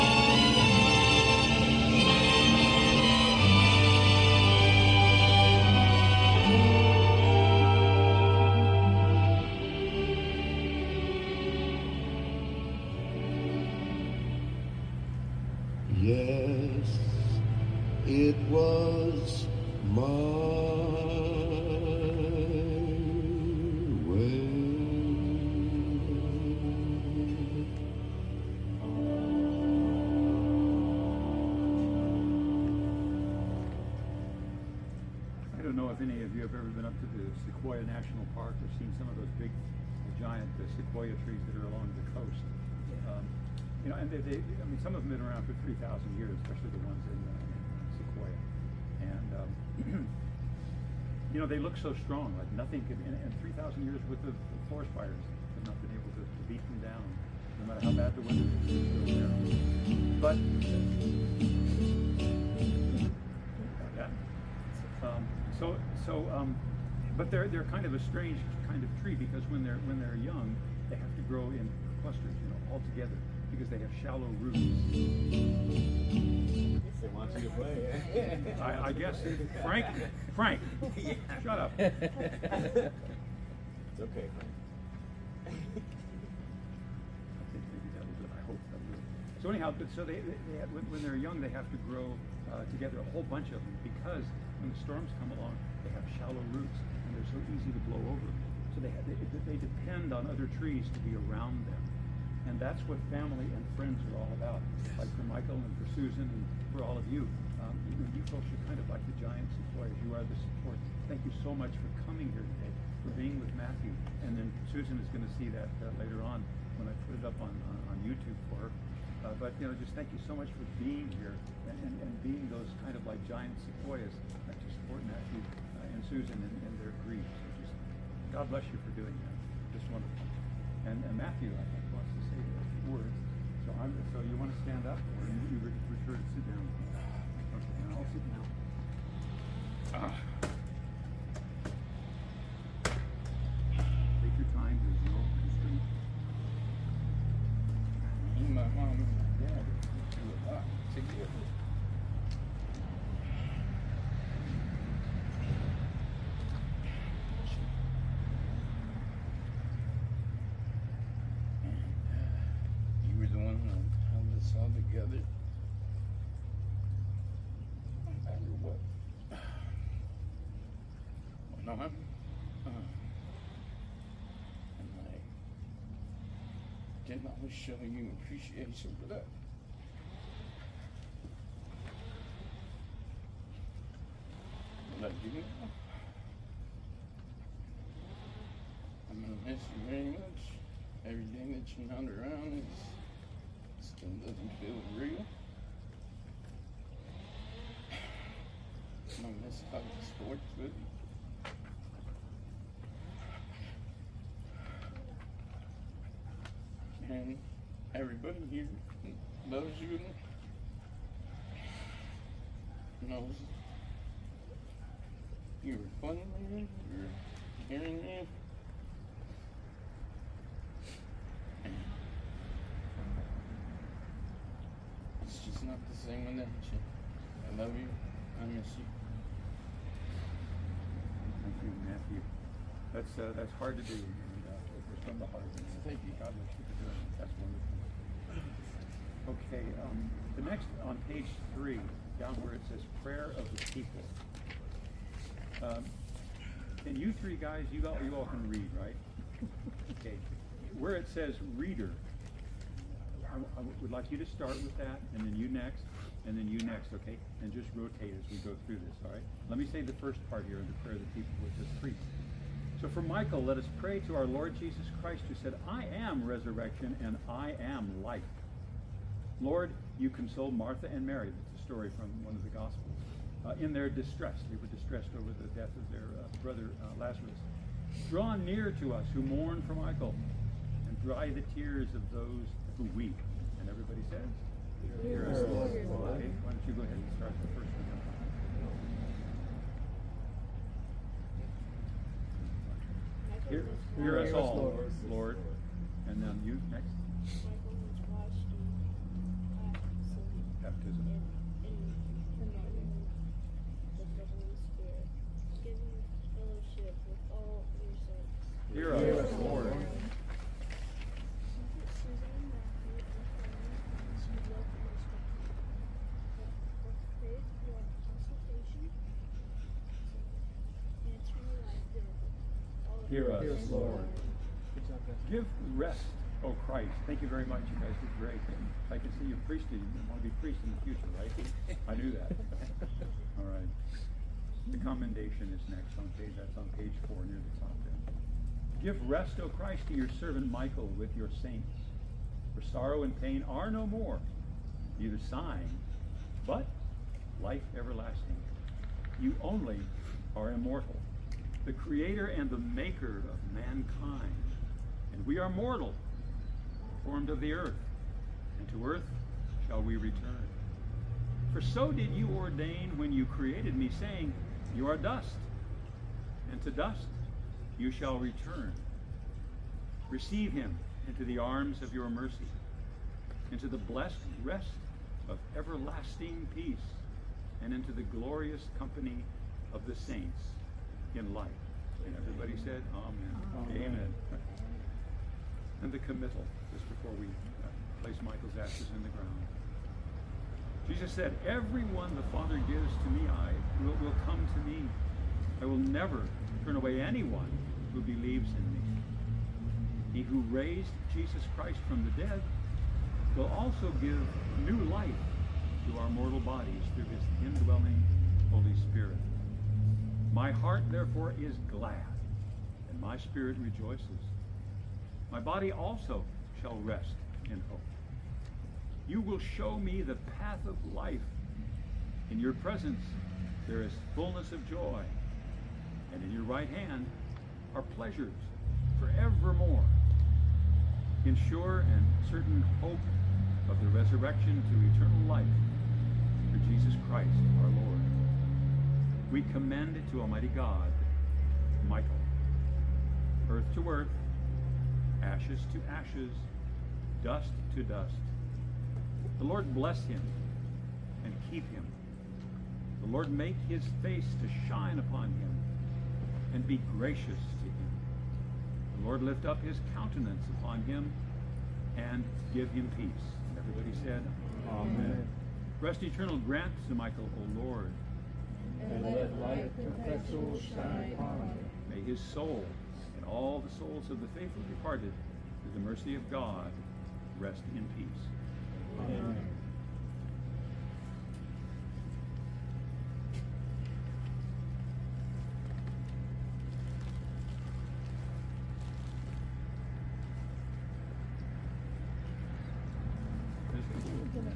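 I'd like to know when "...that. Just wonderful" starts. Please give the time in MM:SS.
02:09.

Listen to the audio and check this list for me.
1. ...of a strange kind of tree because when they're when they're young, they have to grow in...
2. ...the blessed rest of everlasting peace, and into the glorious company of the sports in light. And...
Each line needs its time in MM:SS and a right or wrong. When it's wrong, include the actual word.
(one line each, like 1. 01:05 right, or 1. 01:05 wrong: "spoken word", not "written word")
1. 01:07 right
2. 06:13 wrong: "saints", not "sports".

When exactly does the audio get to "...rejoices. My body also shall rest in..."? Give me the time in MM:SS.
06:53.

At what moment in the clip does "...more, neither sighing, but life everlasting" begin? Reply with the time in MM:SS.
05:43.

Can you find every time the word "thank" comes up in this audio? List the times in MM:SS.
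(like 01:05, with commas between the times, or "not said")
01:51, 01:59, 03:51, 03:55, 05:27.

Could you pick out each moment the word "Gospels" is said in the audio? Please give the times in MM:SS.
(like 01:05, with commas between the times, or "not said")
04:32.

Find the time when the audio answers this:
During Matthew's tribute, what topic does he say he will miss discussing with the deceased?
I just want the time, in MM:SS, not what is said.
03:20.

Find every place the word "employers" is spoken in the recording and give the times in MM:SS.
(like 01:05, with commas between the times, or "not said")
01:49.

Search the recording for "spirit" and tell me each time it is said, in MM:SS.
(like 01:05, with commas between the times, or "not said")
06:48, 06:53.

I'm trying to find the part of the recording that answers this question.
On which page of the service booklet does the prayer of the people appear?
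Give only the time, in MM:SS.
04:01.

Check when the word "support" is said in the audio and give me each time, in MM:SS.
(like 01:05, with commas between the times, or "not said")
01:50, 02:04.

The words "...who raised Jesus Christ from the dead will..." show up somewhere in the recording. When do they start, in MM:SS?
06:40.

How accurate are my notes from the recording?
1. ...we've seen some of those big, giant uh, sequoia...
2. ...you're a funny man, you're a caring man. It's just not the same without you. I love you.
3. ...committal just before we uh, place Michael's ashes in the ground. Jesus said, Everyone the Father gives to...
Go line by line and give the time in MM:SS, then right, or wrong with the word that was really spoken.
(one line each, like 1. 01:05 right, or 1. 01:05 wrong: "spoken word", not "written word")
1. 00:38 right
2. 03:35 right
3. 06:25 right.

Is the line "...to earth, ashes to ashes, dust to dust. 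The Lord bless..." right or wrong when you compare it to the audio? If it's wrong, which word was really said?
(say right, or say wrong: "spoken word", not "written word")
right.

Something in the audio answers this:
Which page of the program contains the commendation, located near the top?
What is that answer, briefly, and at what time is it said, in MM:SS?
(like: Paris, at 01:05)
Page four, at 05:36.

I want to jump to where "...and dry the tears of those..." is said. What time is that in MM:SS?
04:40.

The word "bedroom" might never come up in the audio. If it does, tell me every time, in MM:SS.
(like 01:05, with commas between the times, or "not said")
not said.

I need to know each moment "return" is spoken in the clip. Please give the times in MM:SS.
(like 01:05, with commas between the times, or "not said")
05:59, 06:08.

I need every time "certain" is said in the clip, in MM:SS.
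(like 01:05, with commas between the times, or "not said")
07:12.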